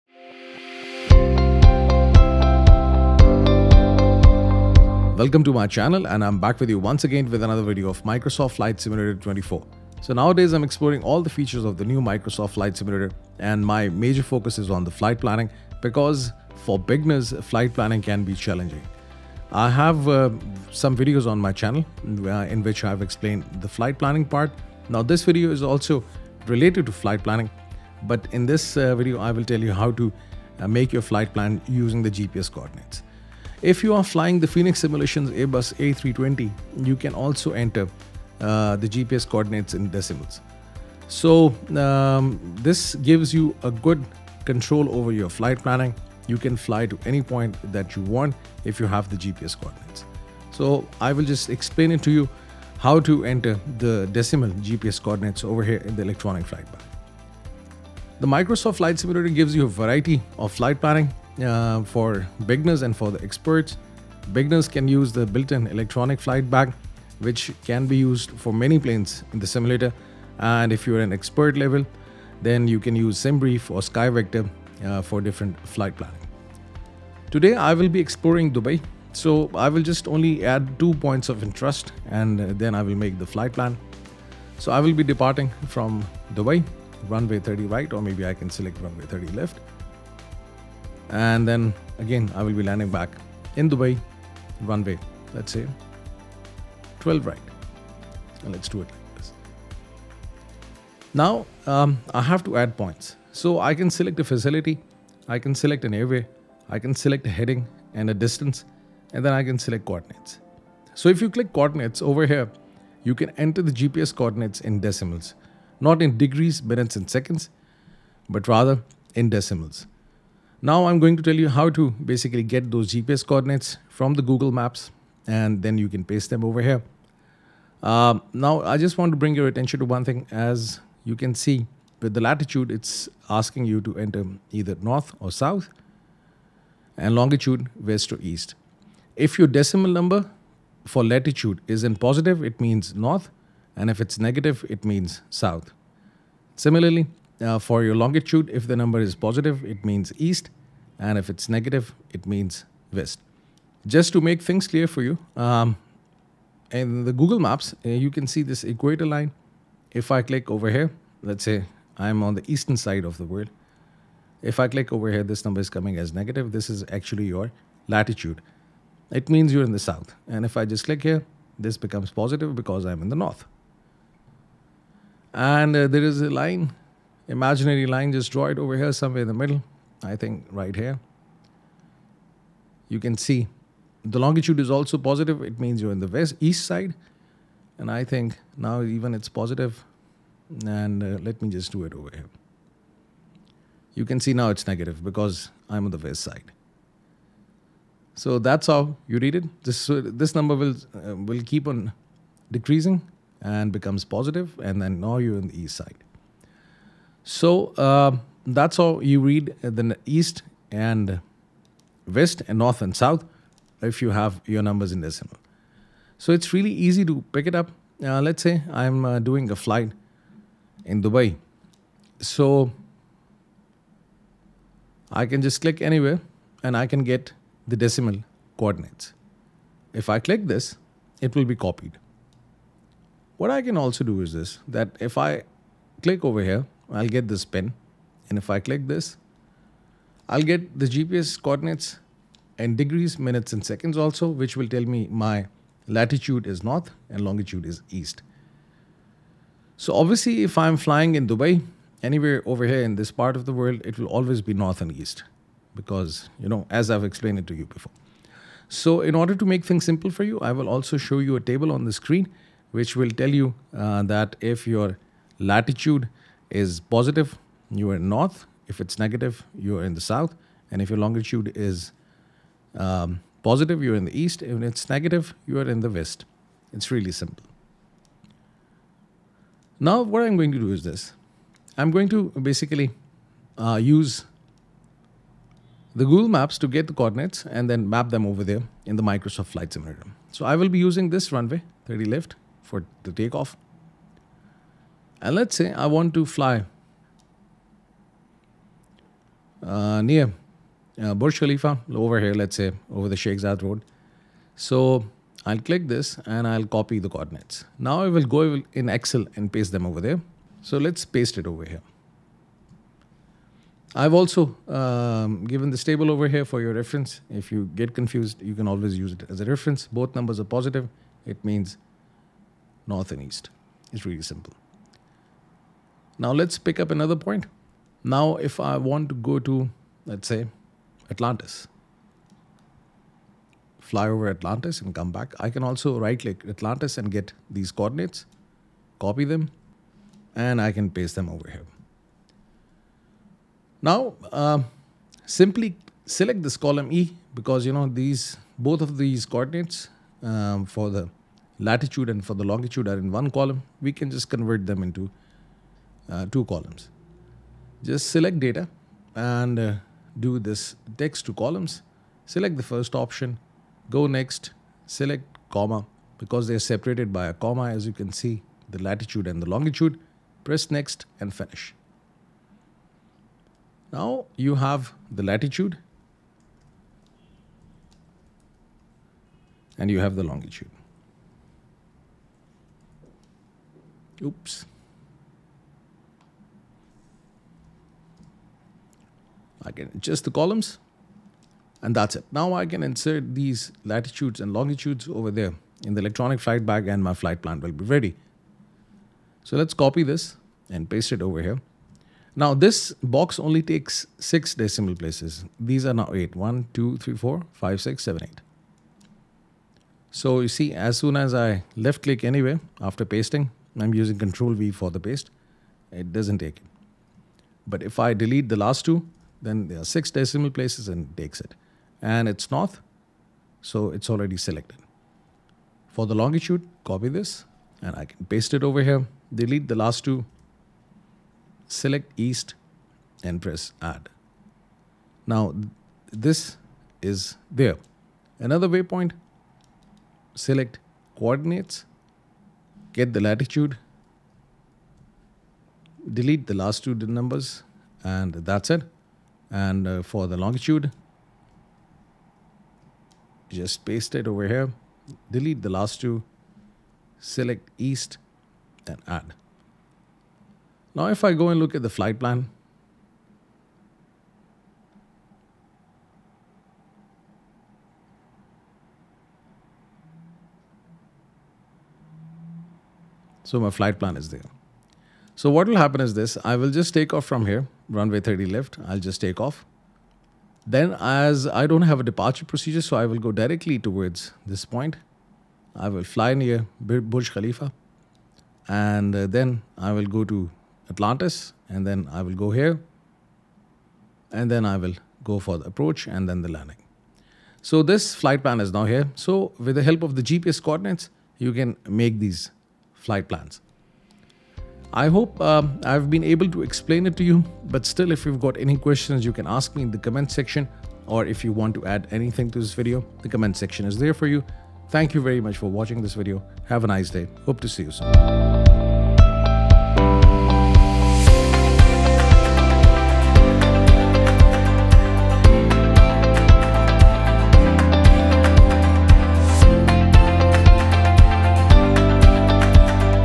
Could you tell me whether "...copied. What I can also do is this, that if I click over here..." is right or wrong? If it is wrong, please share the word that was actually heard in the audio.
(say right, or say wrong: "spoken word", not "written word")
right.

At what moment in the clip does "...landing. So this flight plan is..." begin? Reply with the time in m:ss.
8:16.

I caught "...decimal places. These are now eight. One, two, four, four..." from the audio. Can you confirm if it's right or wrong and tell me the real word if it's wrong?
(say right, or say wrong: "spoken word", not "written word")
wrong: "three", not "four".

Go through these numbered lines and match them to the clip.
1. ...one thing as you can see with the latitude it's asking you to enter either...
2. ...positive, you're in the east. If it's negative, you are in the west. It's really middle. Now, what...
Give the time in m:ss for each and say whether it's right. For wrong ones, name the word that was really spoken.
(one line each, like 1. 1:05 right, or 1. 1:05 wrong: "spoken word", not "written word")
1. 2:09 right
2. 4:33 wrong: "simple", not "middle".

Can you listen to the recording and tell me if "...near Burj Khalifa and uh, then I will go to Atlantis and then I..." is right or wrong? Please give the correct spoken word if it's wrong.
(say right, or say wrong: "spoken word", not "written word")
right.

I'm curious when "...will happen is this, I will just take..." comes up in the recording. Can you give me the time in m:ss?
7:55.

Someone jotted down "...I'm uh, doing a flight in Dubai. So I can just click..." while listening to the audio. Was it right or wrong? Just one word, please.
right.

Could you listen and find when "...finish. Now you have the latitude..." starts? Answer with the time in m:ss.
6:11.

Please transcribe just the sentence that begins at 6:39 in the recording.
So let's copy this and paste it over here.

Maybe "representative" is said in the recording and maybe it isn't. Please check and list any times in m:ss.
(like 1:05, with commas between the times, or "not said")
not said.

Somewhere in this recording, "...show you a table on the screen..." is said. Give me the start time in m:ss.
4:20.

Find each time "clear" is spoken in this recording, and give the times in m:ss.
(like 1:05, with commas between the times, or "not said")
2:34.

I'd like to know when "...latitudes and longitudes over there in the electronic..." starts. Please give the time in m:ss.
6:33.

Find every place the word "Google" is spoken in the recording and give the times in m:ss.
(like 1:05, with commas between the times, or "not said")
2:04, 2:37, 4:46.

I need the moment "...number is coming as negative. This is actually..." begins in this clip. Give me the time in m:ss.
2:45.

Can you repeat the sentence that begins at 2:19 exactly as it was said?
If your decimal number for latitude is in positive it means north and if it's negative it means south.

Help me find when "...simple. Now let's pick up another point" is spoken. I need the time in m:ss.
5:24.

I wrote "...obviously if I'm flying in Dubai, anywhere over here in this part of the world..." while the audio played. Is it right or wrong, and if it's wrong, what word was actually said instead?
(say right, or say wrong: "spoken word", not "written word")
right.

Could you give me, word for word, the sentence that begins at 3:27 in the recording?
So uh, that's how you read the east and west and north and south if you have your numbers in decimal.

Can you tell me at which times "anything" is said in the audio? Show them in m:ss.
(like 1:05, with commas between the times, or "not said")
8:32.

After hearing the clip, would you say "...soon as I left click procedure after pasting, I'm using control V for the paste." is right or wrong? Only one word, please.
wrong.